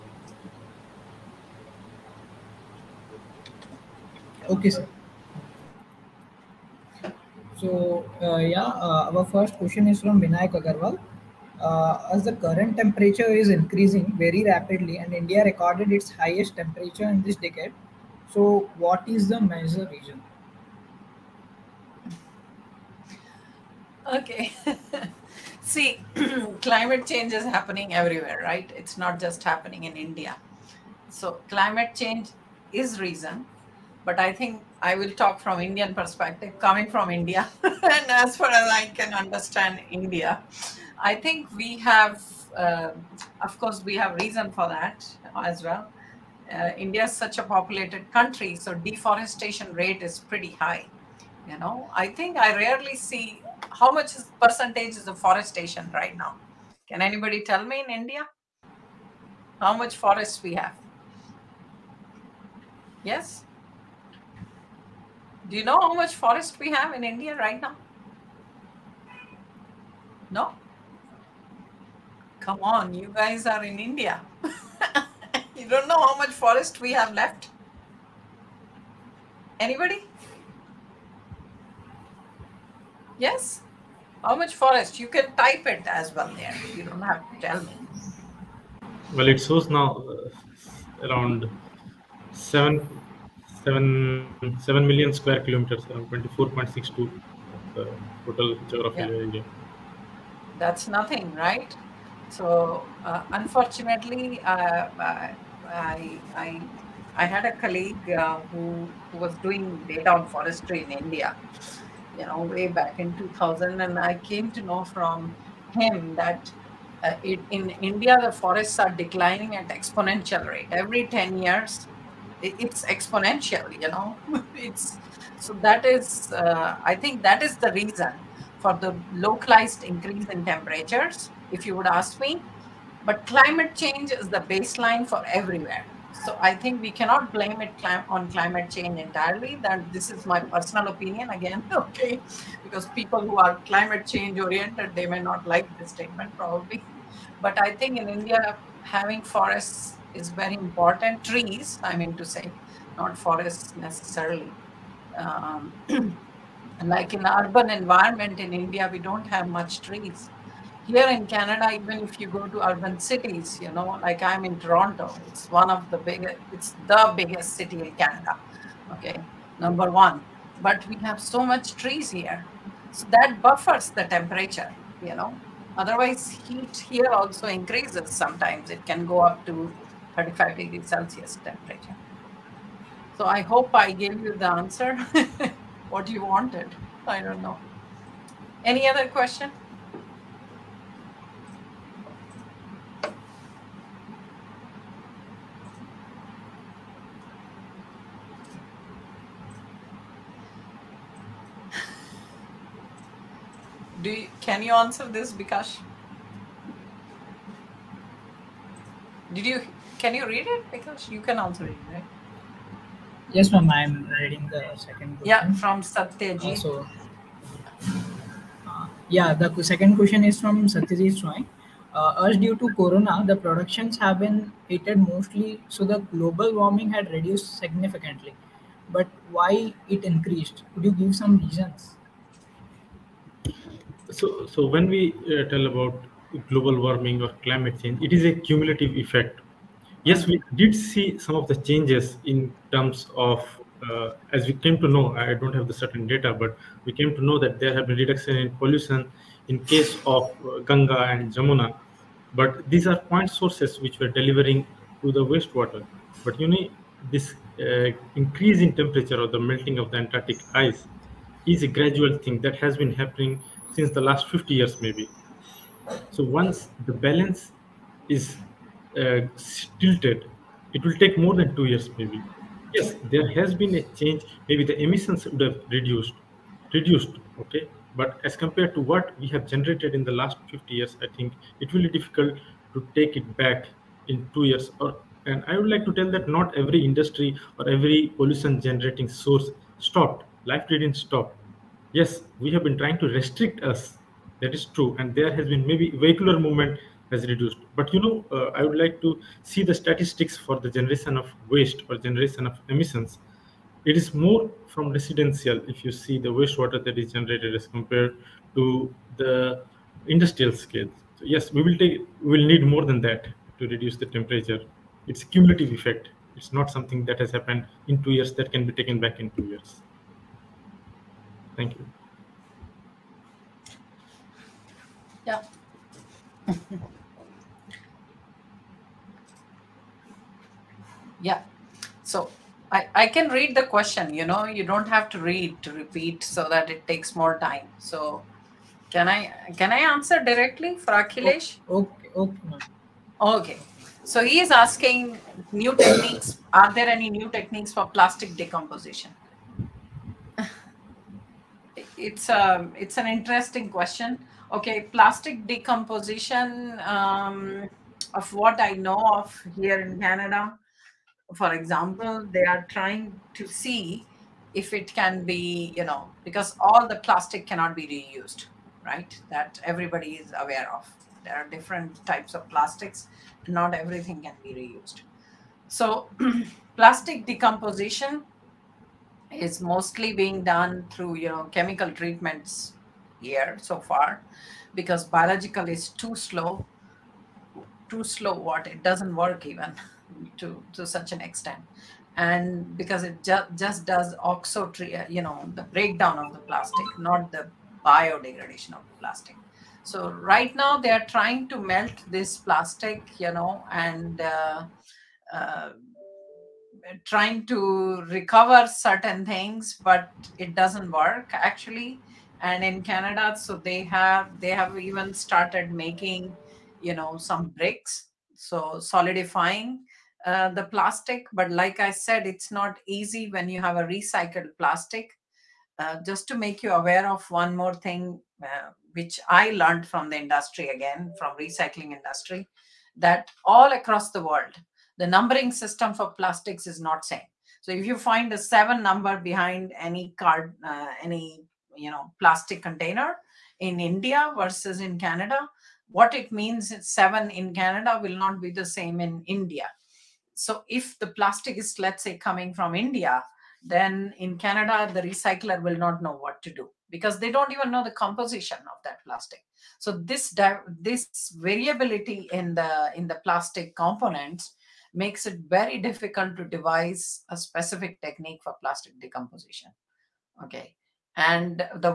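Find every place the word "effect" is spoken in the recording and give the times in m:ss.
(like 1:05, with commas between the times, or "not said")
3:59, 5:15.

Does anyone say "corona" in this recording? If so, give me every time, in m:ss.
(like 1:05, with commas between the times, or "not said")
3:42.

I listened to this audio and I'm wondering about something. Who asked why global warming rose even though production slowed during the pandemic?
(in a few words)
Satyajit Swami.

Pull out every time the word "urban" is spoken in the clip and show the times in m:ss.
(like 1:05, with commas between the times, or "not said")
2:37, 2:42.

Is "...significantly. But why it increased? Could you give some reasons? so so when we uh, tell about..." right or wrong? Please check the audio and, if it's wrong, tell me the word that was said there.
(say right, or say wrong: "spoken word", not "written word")
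right.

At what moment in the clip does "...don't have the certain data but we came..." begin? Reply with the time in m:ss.
4:05.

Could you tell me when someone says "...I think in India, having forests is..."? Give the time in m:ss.
2:27.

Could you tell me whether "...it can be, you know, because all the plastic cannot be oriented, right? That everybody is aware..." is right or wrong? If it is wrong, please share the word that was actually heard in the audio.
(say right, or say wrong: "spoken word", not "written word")
wrong: "reused", not "oriented".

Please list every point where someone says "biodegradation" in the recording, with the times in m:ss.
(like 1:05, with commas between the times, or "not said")
6:37.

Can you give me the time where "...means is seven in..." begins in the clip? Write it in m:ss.
7:26.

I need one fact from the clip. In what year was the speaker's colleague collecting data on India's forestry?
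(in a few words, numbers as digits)
2000.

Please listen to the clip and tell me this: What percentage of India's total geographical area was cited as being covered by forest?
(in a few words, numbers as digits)
24.62.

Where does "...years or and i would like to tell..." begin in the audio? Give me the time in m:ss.
4:44.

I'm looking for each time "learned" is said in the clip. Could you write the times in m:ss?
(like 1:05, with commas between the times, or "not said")
7:09.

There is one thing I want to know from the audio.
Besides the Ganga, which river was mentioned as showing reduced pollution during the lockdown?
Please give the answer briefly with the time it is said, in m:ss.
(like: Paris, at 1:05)
Jamuna, at 4:11.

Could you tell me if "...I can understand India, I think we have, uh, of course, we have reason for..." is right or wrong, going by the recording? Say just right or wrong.
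right.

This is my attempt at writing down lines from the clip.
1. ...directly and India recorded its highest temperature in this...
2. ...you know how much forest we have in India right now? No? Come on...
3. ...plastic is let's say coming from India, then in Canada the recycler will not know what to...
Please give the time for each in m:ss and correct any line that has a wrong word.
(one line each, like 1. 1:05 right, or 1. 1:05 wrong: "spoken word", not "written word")
1. 0:14 wrong: "rapidly", not "directly"
2. 1:05 right
3. 7:31 right.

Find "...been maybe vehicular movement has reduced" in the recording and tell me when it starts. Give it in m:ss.
4:55.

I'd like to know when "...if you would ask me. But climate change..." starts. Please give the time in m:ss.
2:11.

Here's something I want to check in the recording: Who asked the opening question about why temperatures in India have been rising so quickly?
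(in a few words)
Vinayak Agarwal.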